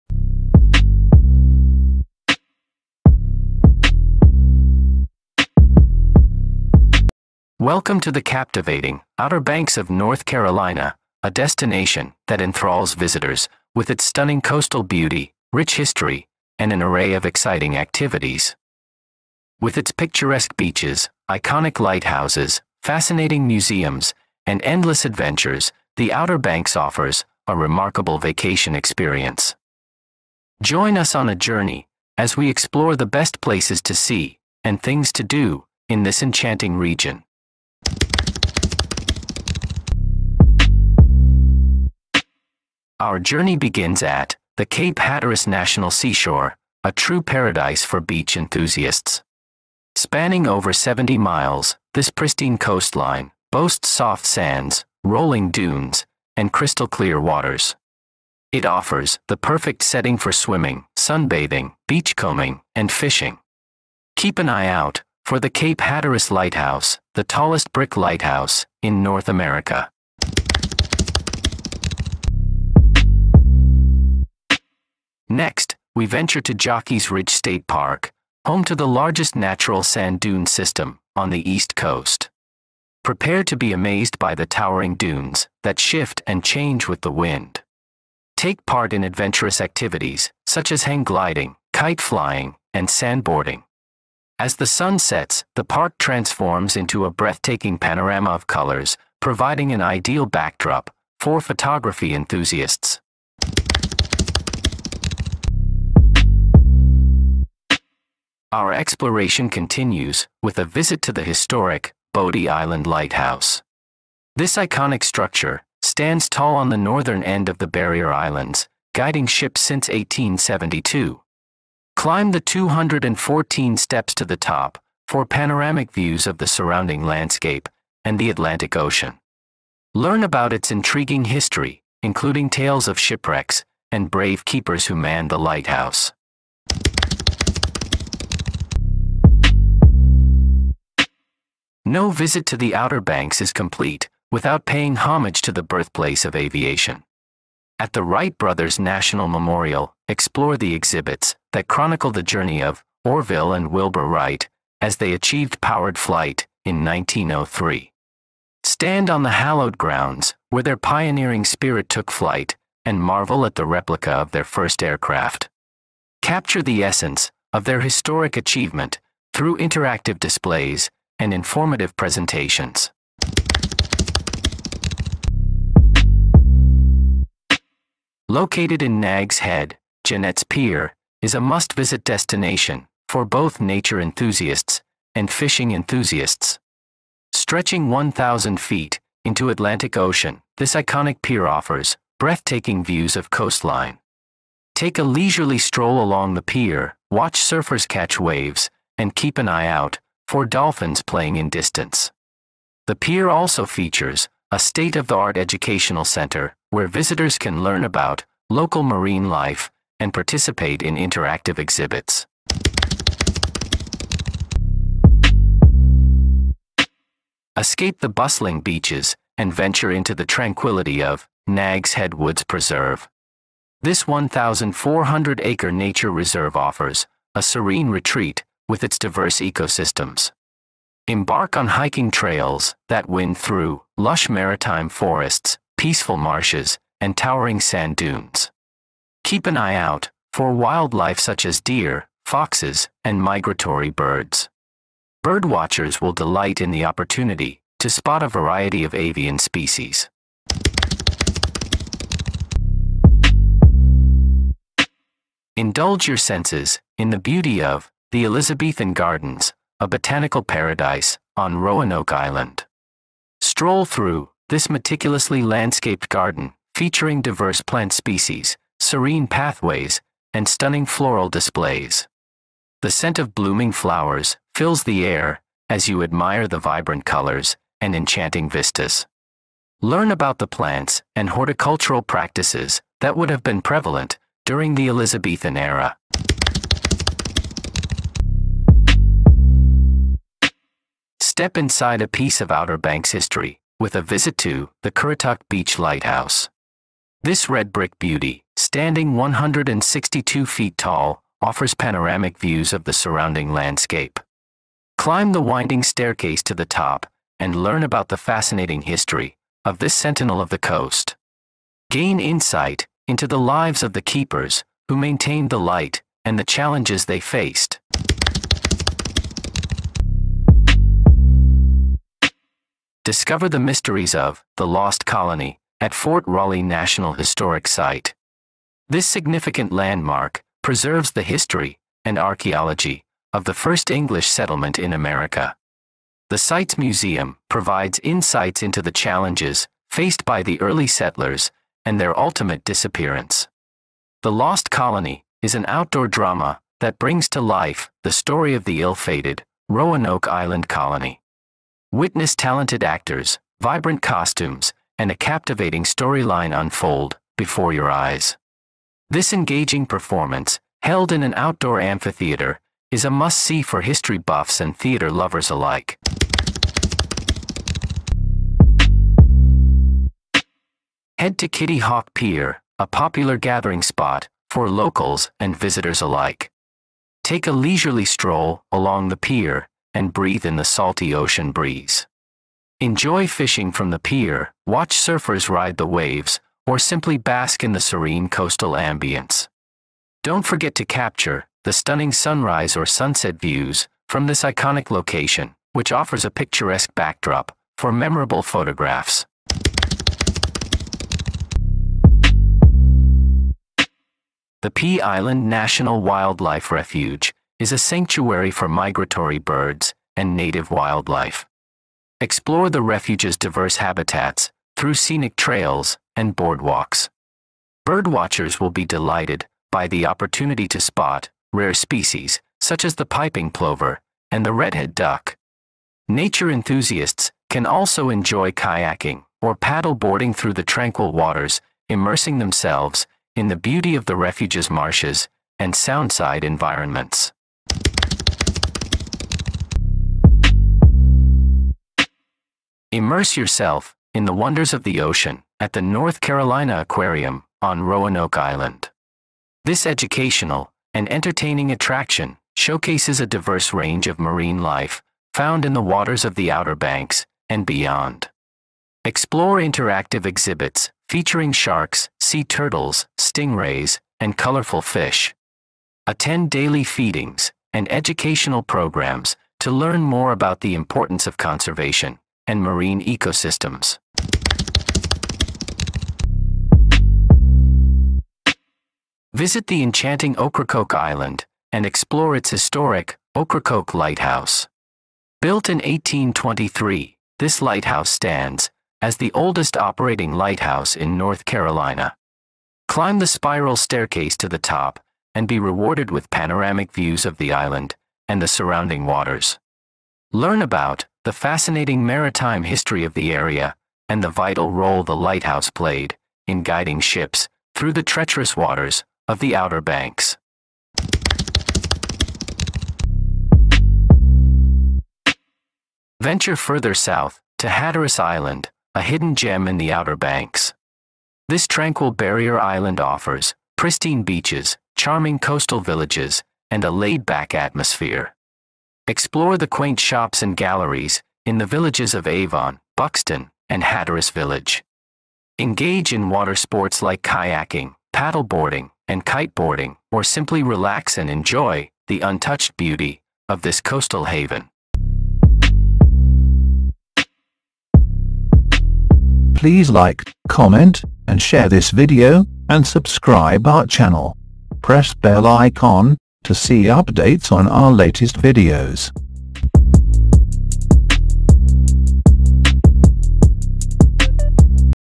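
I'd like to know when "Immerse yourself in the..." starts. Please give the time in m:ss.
7:23.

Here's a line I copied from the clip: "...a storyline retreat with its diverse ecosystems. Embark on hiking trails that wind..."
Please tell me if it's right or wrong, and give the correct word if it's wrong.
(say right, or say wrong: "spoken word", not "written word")
wrong: "serene", not "storyline".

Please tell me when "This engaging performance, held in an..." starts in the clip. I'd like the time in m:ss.
5:59.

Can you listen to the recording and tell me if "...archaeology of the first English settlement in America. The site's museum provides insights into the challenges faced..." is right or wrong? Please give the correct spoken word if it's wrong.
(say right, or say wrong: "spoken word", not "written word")
right.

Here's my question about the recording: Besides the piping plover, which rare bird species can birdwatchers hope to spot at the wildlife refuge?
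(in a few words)
redhead duck.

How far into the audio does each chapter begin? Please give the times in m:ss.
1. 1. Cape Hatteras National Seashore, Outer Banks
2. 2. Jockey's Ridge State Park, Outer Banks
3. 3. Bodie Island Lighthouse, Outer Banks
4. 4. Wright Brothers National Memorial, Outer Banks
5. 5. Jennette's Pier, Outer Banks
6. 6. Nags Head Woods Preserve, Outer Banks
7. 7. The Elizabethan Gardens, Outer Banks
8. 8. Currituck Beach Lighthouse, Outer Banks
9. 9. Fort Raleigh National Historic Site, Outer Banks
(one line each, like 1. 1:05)
1. 0:37
2. 1:10
3. 1:43
4. 2:16
5. 2:53
6. 3:32
7. 4:10
8. 4:46
9. 5:17.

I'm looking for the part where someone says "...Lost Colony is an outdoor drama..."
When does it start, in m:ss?
5:44.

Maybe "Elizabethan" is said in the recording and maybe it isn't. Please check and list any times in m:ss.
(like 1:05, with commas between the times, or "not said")
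4:18, 4:44.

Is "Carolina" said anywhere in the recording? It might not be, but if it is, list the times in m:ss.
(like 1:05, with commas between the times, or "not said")
0:10, 7:26, 8:11.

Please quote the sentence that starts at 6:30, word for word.
Don't forget to capture the stunning sunrise or sunset views from this iconic location, which offers a picturesque backdrop for memorable photographs.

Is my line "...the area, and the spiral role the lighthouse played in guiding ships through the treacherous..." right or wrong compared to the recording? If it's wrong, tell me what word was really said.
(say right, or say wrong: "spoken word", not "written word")
wrong: "vital", not "spiral".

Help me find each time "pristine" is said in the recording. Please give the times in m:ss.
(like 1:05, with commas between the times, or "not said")
0:52, 8:43.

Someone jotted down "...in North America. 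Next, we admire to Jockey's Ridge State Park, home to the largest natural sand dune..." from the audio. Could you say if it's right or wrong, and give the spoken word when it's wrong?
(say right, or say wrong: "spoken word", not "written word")
wrong: "venture", not "admire".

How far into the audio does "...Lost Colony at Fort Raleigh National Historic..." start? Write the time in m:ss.
5:24.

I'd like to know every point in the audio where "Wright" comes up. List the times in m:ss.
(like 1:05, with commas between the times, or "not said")
2:28, 2:34.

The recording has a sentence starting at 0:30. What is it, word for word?
Join us on a journey as we explore the best places to see and things to do in this enchanting region.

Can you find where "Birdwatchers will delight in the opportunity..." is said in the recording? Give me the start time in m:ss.
4:05.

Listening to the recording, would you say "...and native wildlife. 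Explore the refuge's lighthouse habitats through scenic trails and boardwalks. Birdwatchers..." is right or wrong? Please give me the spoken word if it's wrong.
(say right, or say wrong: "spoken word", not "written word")
wrong: "diverse", not "lighthouse".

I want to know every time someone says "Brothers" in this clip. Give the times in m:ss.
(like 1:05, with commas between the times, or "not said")
2:28.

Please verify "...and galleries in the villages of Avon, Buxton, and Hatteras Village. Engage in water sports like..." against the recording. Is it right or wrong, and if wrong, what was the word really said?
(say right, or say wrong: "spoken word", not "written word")
right.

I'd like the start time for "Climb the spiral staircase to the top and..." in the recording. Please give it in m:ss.
8:12.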